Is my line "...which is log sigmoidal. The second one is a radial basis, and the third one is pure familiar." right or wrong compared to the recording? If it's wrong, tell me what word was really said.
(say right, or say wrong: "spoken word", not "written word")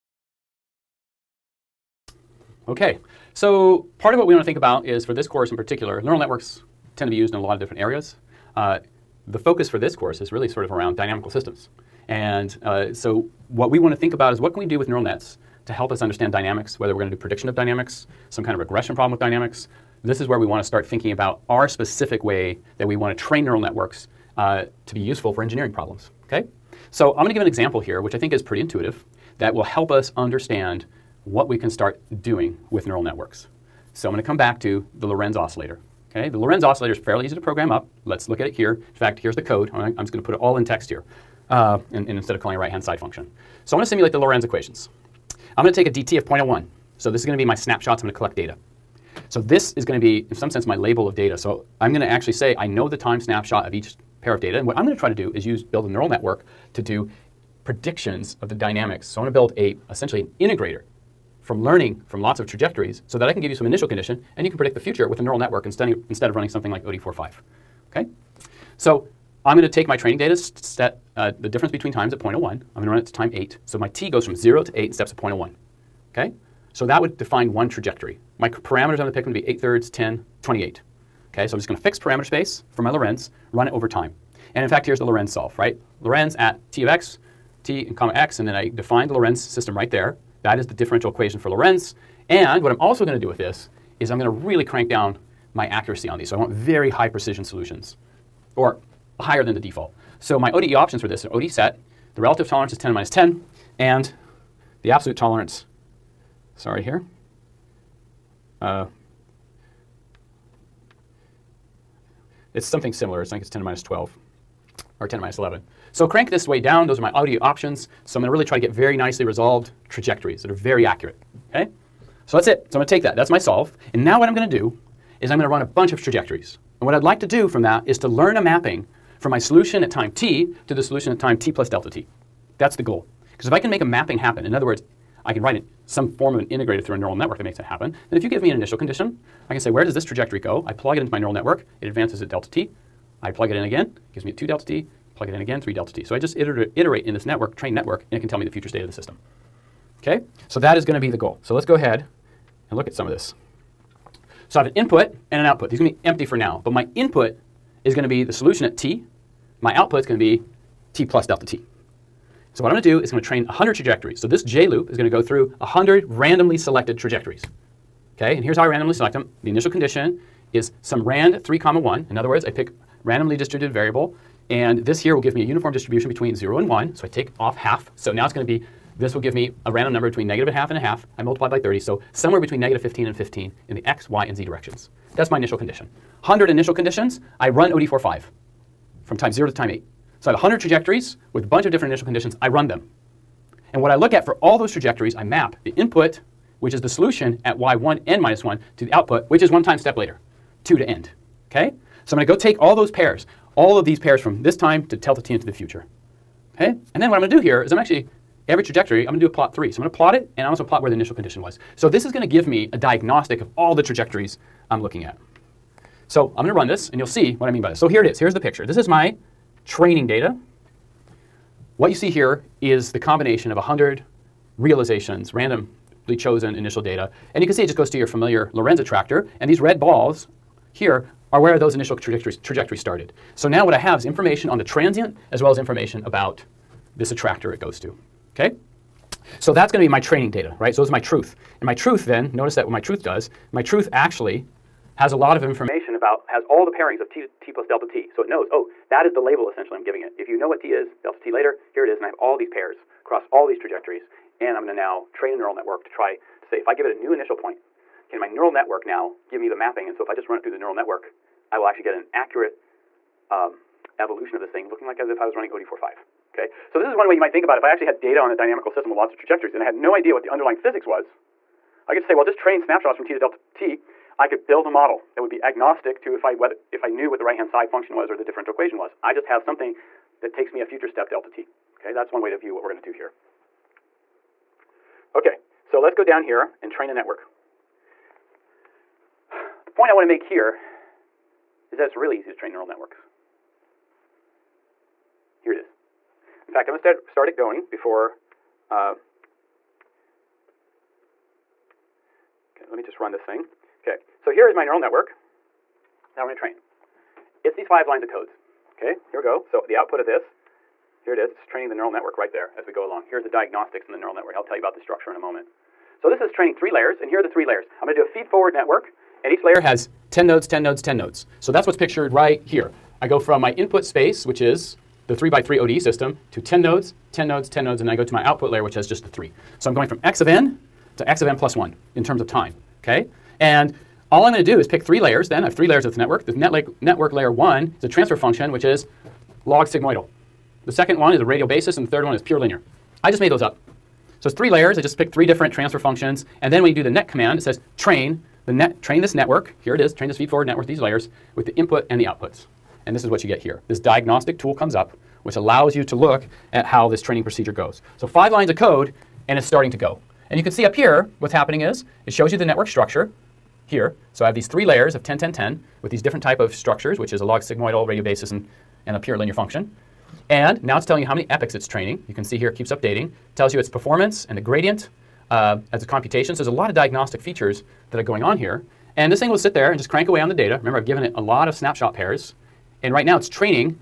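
wrong: "linear", not "familiar".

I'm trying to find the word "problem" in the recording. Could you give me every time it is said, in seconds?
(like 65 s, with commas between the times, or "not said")
18 s, 25 s.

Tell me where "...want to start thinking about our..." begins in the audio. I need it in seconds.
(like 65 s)
20 s.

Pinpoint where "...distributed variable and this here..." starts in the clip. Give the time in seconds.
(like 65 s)
173 s.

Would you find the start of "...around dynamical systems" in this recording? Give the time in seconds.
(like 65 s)
10 s.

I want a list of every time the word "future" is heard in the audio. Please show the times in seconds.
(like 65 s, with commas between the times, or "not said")
64 s, 148 s, 205 s, 280 s.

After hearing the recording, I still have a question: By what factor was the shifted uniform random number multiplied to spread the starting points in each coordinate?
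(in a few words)
30.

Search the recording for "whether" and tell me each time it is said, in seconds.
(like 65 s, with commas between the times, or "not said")
16 s, 276 s.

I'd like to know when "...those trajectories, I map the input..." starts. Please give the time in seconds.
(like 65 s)
194 s.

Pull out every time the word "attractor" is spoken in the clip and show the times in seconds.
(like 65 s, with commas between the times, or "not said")
228 s, 237 s.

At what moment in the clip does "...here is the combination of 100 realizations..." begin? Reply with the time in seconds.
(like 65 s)
222 s.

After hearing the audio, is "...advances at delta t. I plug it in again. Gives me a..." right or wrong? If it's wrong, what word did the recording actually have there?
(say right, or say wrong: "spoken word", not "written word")
right.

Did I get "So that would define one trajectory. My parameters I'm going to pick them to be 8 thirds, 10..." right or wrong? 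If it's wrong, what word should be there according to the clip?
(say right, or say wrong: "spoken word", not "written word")
right.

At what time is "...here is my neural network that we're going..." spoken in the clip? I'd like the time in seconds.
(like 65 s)
304 s.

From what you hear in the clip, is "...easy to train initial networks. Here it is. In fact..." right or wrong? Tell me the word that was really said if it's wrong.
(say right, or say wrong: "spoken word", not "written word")
wrong: "neural", not "initial".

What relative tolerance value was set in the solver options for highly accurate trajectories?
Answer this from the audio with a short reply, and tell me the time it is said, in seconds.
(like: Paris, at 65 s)
10 minus 10, at 102 s.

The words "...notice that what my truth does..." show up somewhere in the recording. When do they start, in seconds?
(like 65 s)
242 s.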